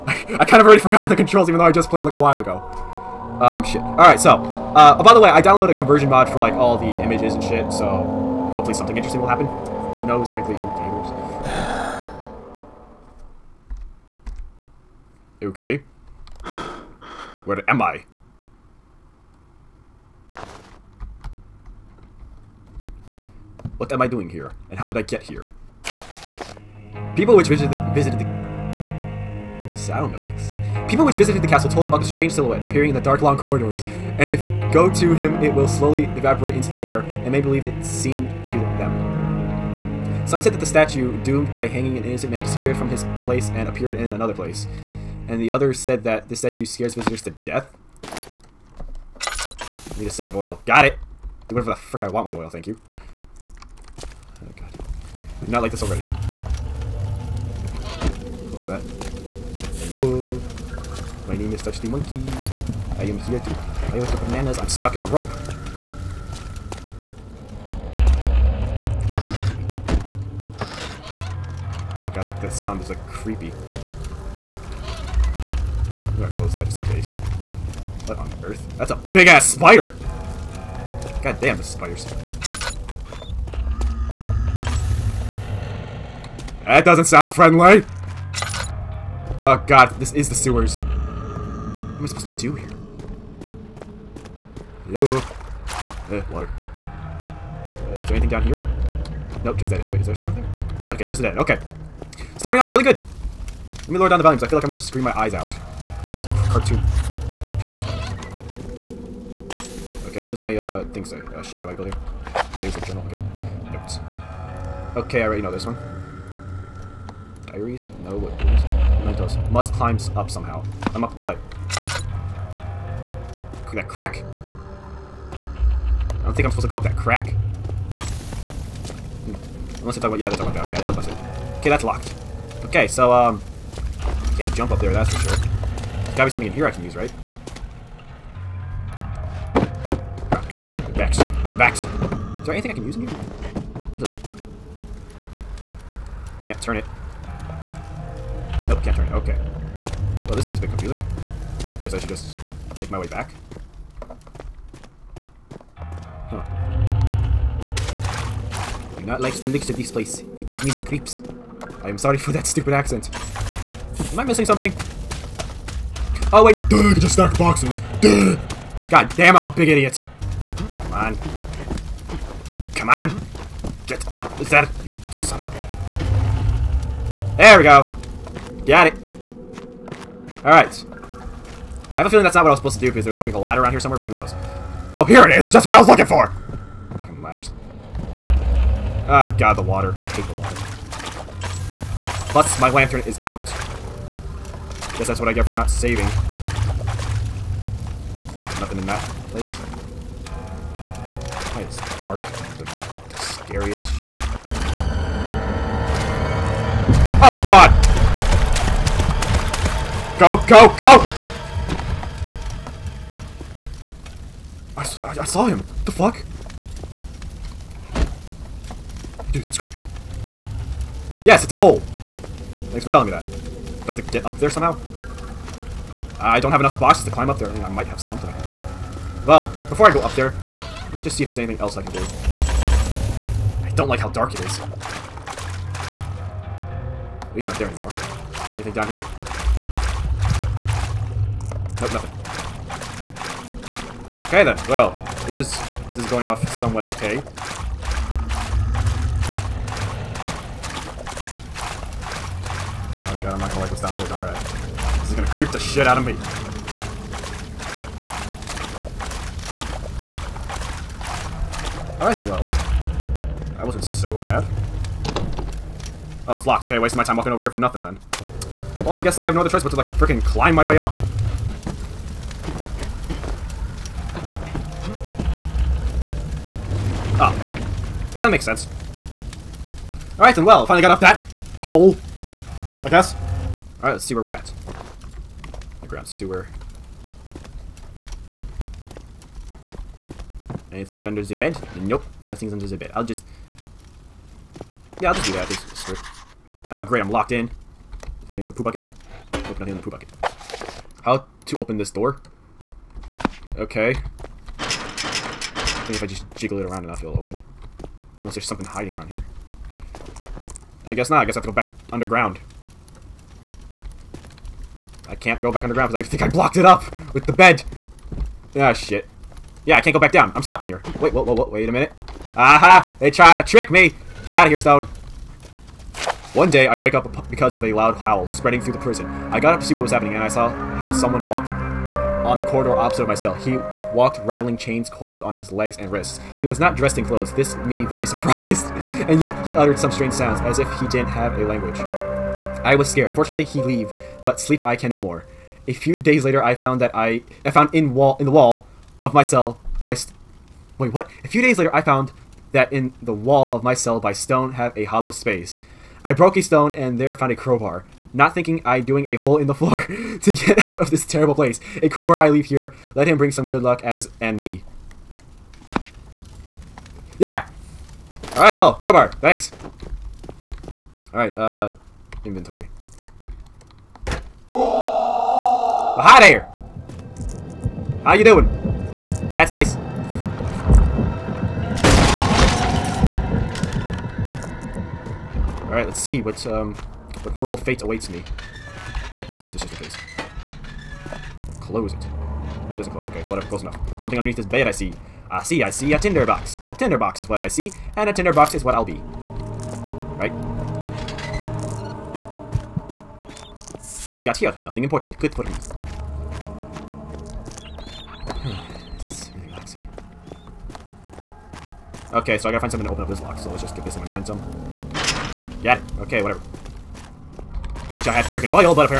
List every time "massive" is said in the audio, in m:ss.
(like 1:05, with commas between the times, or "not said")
not said.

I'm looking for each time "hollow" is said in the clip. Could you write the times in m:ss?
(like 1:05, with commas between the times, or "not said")
5:54.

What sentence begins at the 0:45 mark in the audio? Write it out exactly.
And the others said that the statue scares visitors to death.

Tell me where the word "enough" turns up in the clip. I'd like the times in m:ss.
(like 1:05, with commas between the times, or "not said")
3:46, 5:06, 6:33.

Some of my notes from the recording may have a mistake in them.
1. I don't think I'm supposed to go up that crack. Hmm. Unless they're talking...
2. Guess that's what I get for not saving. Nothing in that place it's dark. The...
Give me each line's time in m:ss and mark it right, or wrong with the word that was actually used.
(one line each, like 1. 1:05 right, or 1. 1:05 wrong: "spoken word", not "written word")
1. 2:06 right
2. 3:14 right.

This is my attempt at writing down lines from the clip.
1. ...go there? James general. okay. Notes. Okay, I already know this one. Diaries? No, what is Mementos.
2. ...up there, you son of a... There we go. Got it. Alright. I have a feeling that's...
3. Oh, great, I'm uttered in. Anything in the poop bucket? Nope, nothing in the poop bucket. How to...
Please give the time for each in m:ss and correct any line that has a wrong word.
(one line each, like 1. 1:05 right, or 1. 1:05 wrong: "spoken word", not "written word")
1. 1:51 right
2. 2:54 right
3. 4:56 wrong: "locked", not "uttered".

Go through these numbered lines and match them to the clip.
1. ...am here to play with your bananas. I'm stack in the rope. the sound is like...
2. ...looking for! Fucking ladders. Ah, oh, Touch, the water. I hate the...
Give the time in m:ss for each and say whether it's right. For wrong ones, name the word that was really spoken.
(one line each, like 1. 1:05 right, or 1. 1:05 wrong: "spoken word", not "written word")
1. 1:03 wrong: "stuck", not "stack"
2. 3:05 wrong: "God", not "Touch".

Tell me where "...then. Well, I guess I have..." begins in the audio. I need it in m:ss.
4:27.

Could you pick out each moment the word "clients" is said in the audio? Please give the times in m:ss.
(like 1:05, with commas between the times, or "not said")
not said.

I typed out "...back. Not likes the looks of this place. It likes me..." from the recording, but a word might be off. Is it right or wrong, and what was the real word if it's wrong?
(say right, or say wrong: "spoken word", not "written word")
wrong: "gives", not "likes".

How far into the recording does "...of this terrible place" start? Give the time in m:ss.
6:00.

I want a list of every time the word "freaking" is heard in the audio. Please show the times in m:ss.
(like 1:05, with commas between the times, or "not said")
4:29, 6:58.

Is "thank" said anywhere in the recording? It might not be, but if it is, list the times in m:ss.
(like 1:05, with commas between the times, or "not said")
0:52, 3:42, 6:09.